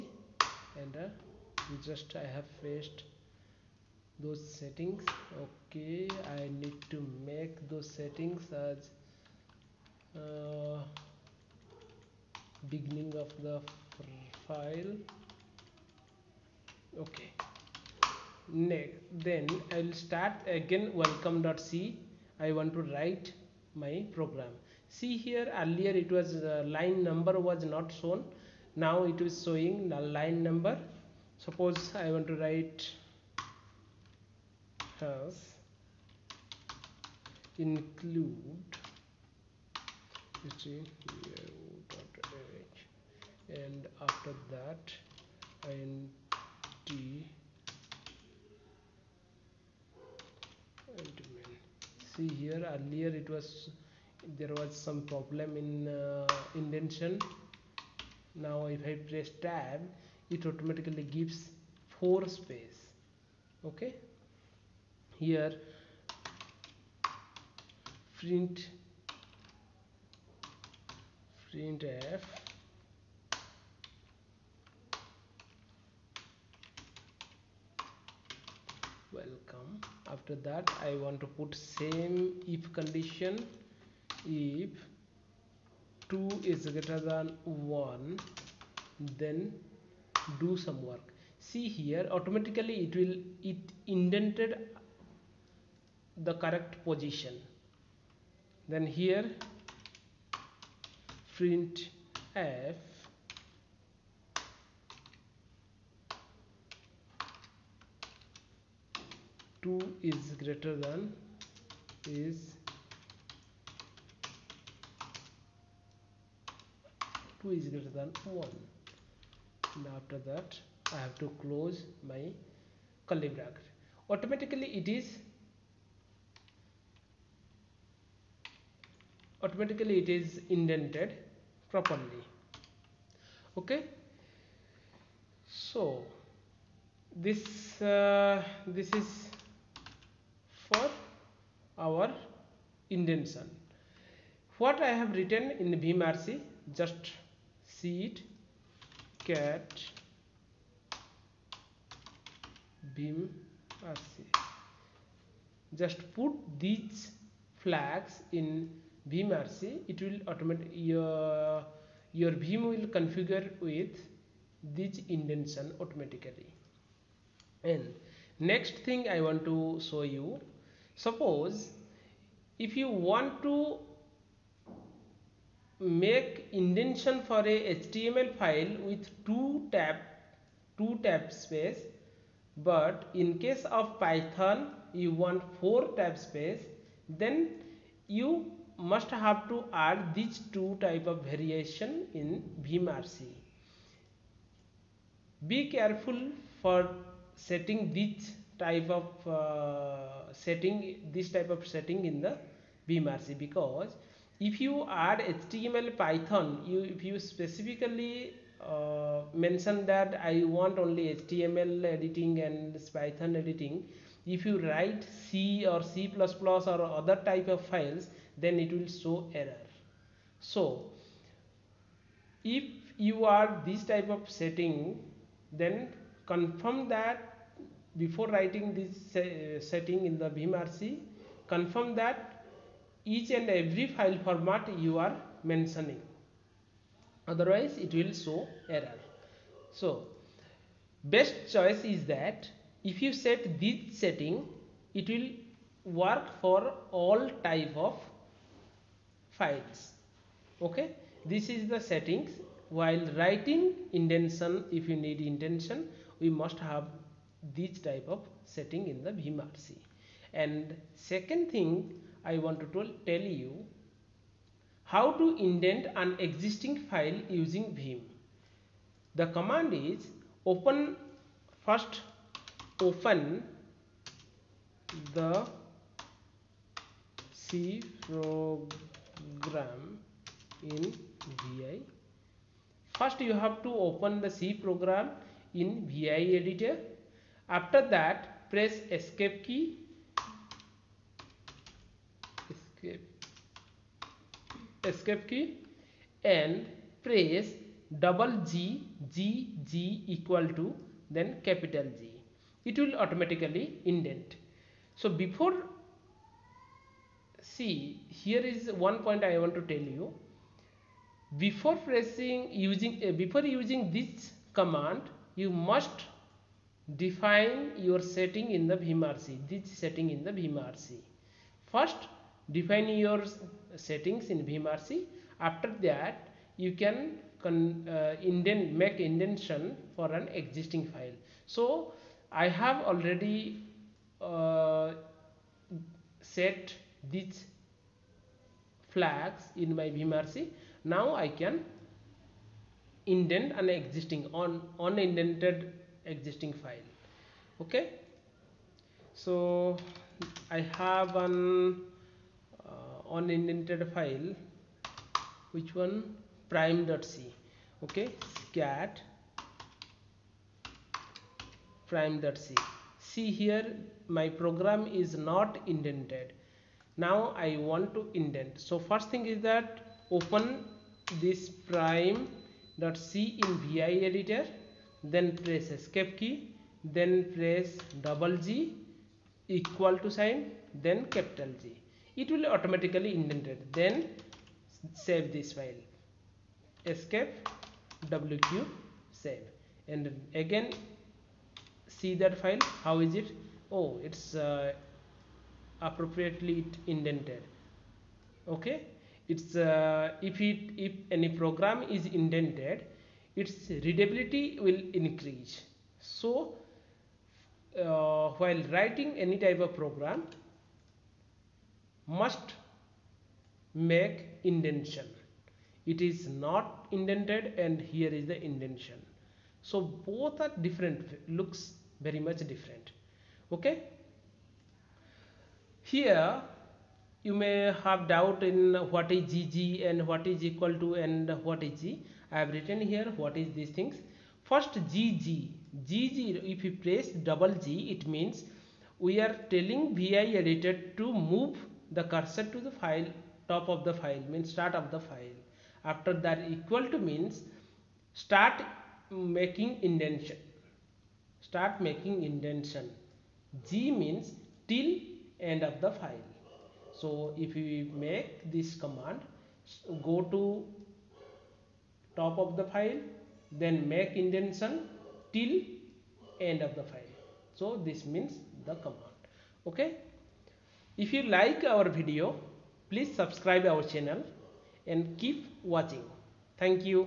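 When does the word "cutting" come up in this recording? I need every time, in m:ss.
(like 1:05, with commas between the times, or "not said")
not said.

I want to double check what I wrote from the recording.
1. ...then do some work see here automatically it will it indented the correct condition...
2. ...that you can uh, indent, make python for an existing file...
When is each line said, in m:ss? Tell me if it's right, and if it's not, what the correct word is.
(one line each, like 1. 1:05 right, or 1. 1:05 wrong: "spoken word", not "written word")
1. 1:29 wrong: "position", not "condition"
2. 5:25 wrong: "indentation", not "python".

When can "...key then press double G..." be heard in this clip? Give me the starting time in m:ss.
6:16.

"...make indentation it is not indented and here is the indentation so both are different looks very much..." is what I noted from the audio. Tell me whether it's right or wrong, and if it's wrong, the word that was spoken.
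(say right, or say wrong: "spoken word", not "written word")
right.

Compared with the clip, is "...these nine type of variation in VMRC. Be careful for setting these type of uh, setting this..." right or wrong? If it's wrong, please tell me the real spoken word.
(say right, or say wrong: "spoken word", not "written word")
wrong: "two", not "nine".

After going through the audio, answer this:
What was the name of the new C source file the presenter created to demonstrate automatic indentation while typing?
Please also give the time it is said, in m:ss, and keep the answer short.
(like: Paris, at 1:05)
welcome.c, at 0:20.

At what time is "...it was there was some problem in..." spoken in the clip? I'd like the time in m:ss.
0:53.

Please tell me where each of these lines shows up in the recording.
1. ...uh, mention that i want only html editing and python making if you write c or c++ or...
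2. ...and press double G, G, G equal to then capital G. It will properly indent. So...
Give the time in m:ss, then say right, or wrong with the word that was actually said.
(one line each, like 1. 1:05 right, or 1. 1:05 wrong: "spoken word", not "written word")
1. 3:28 wrong: "editing", not "making"
2. 4:56 wrong: "automatically", not "properly".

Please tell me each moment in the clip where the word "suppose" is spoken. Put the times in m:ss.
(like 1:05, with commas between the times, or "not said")
0:31, 2:50.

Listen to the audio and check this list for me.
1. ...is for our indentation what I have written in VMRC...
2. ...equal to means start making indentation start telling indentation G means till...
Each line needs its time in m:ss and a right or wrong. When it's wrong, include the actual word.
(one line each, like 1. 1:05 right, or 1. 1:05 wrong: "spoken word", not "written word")
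1. 2:19 right
2. 7:26 wrong: "making", not "telling".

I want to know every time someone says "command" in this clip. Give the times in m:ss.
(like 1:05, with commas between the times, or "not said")
4:29, 5:14, 7:38, 7:48.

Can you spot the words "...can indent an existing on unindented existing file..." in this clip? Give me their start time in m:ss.
5:41.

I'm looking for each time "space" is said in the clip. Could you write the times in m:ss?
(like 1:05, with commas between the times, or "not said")
1:02, 3:01, 3:06.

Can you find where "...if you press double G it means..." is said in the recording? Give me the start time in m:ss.
7:16.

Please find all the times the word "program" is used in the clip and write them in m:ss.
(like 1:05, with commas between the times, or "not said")
0:24, 4:38, 4:44, 6:04, 6:41, 6:49.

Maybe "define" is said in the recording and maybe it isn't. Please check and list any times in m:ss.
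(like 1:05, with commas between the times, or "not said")
5:16, 5:22.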